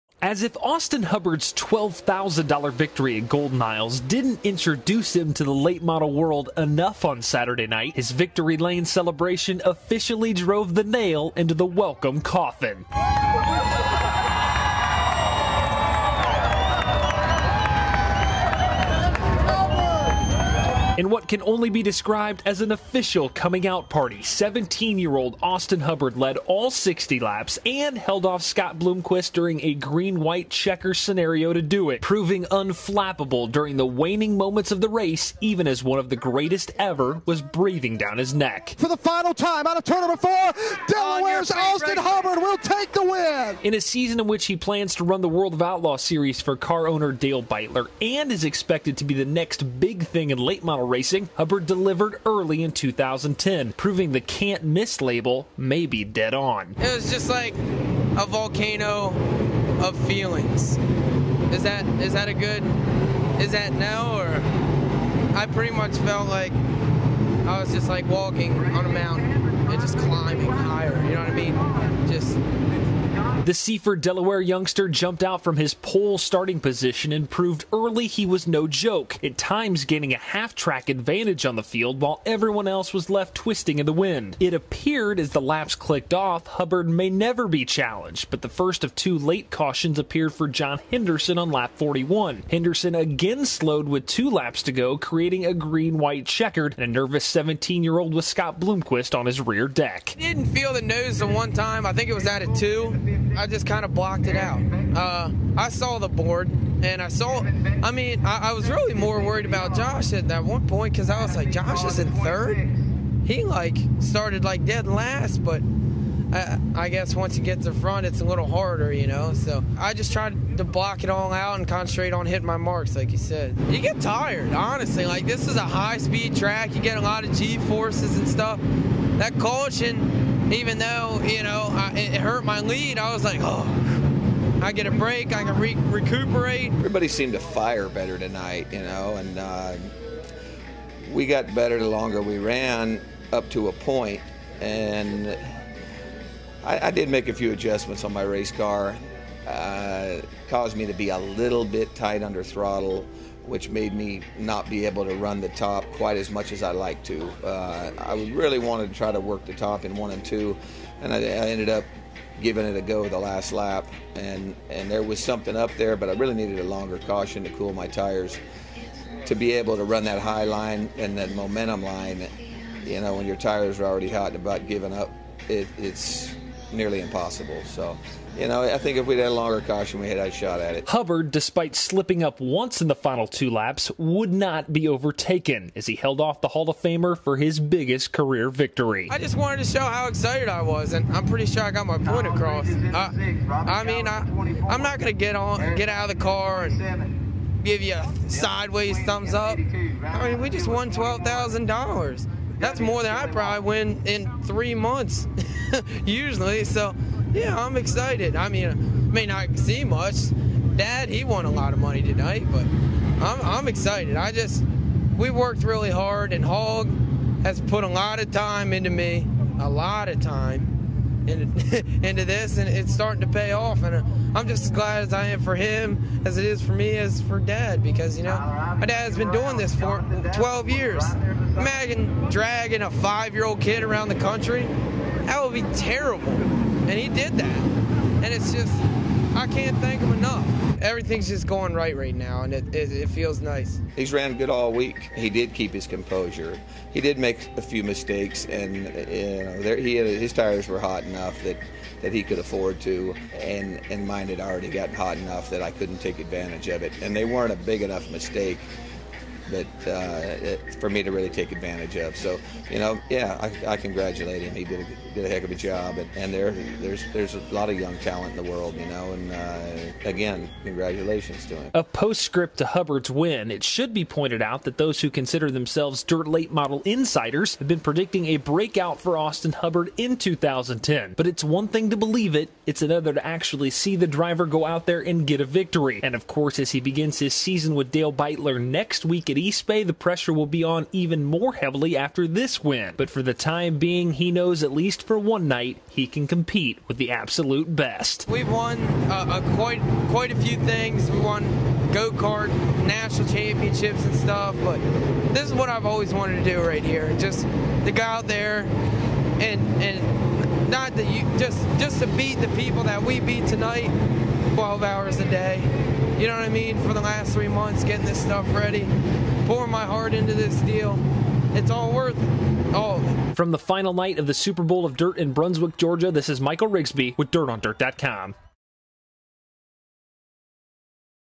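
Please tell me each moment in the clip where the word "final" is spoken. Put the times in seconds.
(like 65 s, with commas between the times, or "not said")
38 s, 182 s, 323 s.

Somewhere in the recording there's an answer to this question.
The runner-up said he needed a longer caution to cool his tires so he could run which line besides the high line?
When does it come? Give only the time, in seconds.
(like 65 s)
171 s.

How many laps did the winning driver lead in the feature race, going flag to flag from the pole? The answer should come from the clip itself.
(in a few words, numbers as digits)
60.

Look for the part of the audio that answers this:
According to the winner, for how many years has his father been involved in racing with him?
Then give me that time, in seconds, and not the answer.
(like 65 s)
230 s.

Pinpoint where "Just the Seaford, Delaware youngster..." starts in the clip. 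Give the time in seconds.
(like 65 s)
72 s.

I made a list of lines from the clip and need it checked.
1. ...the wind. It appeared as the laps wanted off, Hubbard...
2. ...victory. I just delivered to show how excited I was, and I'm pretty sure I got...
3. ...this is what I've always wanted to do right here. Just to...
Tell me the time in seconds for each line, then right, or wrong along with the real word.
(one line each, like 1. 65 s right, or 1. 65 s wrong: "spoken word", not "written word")
1. 83 s wrong: "clicked", not "wanted"
2. 188 s wrong: "wanted", not "delivered"
3. 305 s right.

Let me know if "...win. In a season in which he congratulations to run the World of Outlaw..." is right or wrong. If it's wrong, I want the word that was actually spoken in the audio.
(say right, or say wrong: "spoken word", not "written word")
wrong: "plans", not "congratulations".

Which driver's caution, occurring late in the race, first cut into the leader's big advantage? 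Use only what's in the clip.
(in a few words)
John Henderson.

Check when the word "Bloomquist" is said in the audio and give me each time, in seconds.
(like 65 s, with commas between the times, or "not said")
28 s, 98 s.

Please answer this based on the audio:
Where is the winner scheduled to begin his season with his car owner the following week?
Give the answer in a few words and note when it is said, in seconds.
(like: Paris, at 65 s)
East Bay, at 289 s.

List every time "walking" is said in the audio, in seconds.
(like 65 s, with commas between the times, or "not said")
68 s.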